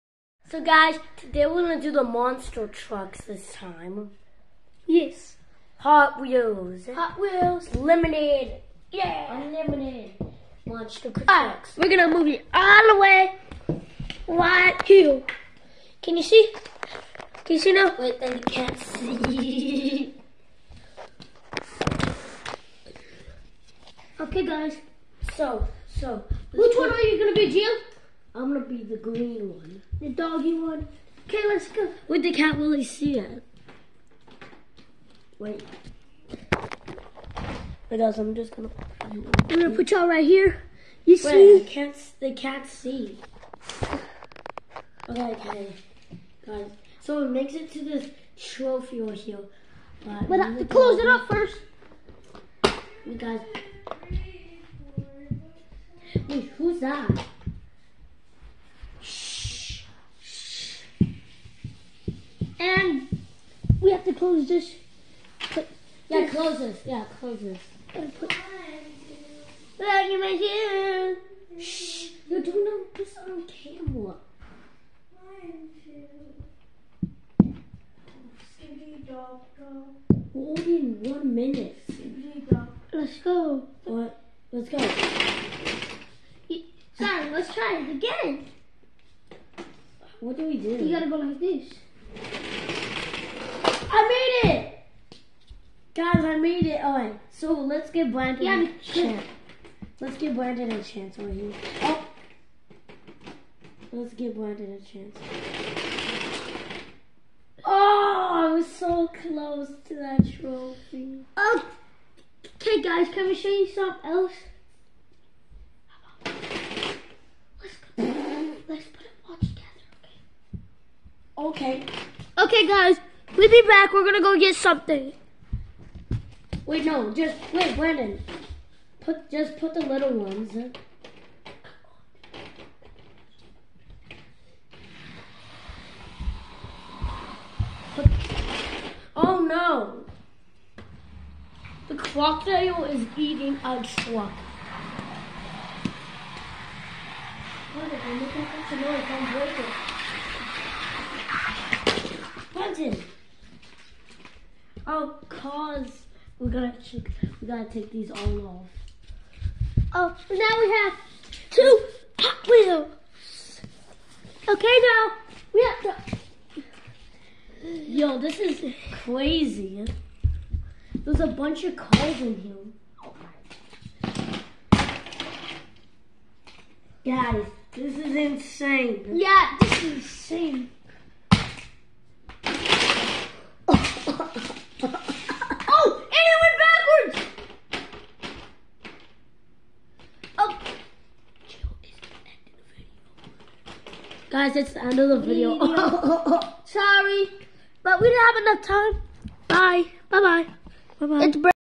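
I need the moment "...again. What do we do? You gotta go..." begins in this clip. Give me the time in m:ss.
1:27.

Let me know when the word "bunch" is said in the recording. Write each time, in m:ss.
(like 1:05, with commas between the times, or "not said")
2:51.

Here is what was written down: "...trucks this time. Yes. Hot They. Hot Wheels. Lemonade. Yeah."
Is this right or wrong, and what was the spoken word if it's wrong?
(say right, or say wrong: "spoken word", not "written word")
wrong: "Wheels", not "They".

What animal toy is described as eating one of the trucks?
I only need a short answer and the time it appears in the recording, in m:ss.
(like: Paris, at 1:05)
Crocodile, at 2:21.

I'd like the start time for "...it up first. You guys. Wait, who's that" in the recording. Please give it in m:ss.
0:50.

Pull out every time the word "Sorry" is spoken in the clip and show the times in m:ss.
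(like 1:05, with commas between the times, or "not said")
1:24, 3:16.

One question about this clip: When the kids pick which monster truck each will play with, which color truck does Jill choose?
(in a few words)
Green.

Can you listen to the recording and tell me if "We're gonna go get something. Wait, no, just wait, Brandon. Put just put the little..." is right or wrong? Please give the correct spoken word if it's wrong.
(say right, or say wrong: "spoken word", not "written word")
right.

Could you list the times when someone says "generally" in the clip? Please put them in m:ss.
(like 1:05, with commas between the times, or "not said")
not said.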